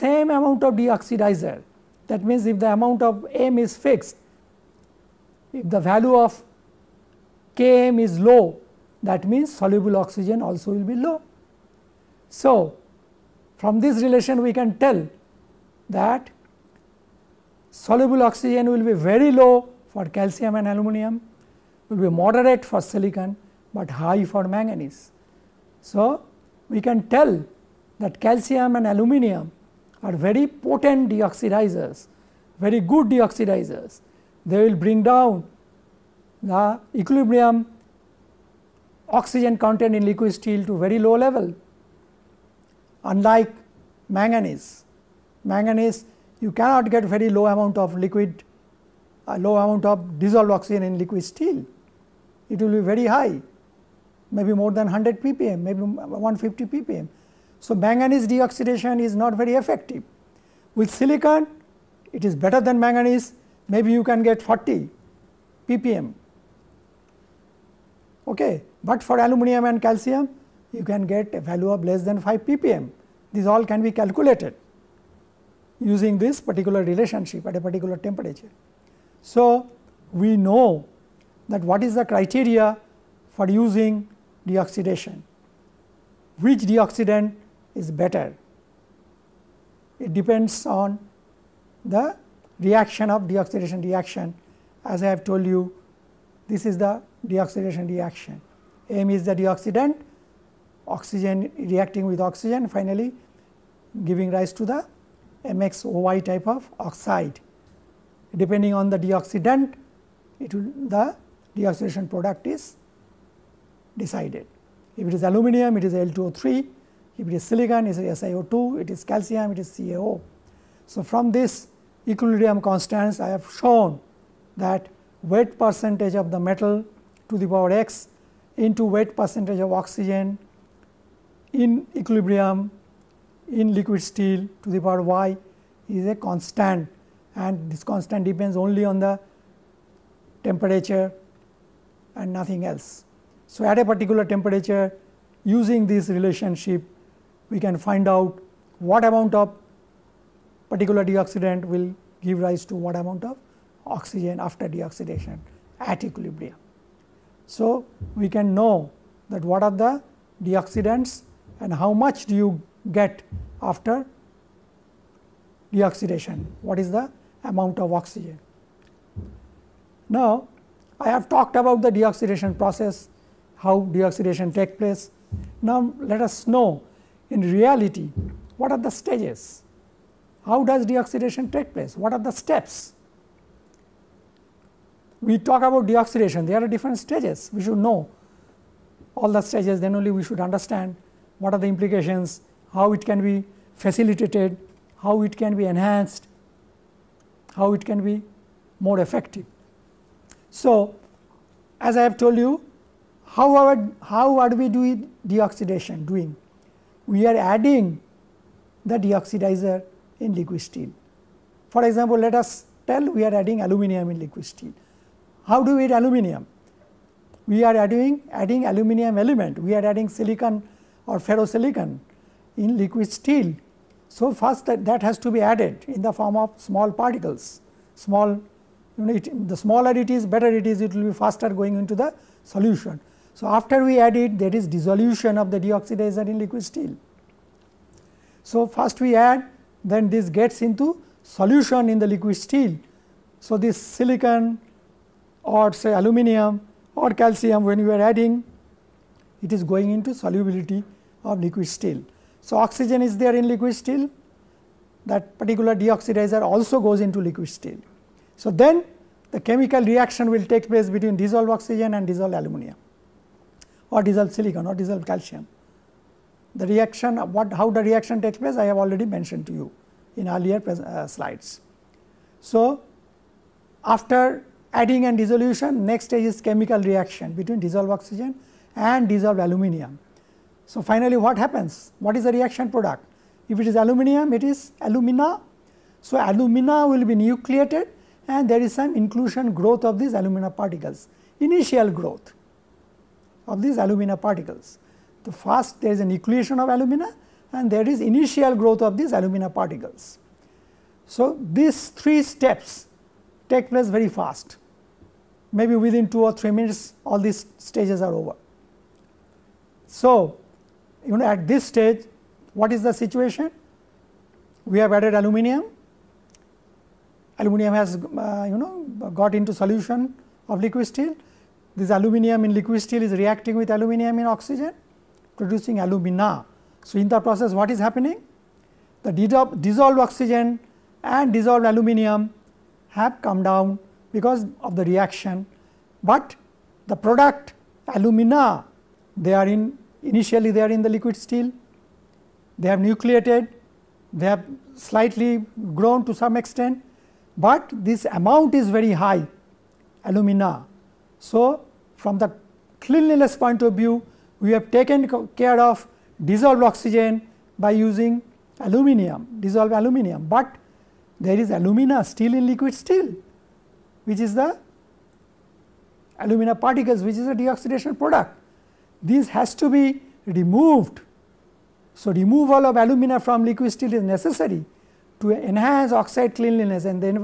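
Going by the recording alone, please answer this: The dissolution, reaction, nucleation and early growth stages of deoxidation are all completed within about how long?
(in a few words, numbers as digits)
2 or 3 minutes.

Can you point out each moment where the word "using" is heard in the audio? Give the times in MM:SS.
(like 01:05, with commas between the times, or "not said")
01:15, 01:23, 02:25, 05:57.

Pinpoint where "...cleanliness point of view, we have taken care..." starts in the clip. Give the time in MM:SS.
05:52.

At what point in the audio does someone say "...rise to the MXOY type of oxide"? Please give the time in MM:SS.
01:44.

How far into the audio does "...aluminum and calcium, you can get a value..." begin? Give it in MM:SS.
01:09.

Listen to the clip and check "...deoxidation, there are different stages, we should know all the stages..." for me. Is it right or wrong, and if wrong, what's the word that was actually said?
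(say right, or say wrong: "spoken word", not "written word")
right.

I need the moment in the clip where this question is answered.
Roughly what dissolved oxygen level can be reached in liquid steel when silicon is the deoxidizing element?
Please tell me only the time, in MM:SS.
01:04.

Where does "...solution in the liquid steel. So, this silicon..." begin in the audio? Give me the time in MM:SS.
04:01.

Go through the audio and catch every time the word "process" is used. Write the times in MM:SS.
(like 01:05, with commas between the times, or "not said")
02:52, 05:27.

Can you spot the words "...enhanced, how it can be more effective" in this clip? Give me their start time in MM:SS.
03:15.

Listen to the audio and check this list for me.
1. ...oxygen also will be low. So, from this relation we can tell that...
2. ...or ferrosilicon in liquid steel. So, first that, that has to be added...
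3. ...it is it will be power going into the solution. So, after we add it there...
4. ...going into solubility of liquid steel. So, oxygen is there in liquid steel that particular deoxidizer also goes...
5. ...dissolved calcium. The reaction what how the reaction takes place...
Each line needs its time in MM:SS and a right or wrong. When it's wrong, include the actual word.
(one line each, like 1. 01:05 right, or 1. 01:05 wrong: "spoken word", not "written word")
1. 00:09 right
2. 03:41 right
3. 03:50 wrong: "faster", not "power"
4. 04:09 right
5. 04:24 right.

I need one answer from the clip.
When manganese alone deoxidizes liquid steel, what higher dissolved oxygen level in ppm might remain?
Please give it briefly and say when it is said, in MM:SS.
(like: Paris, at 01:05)
150 ppm, at 00:55.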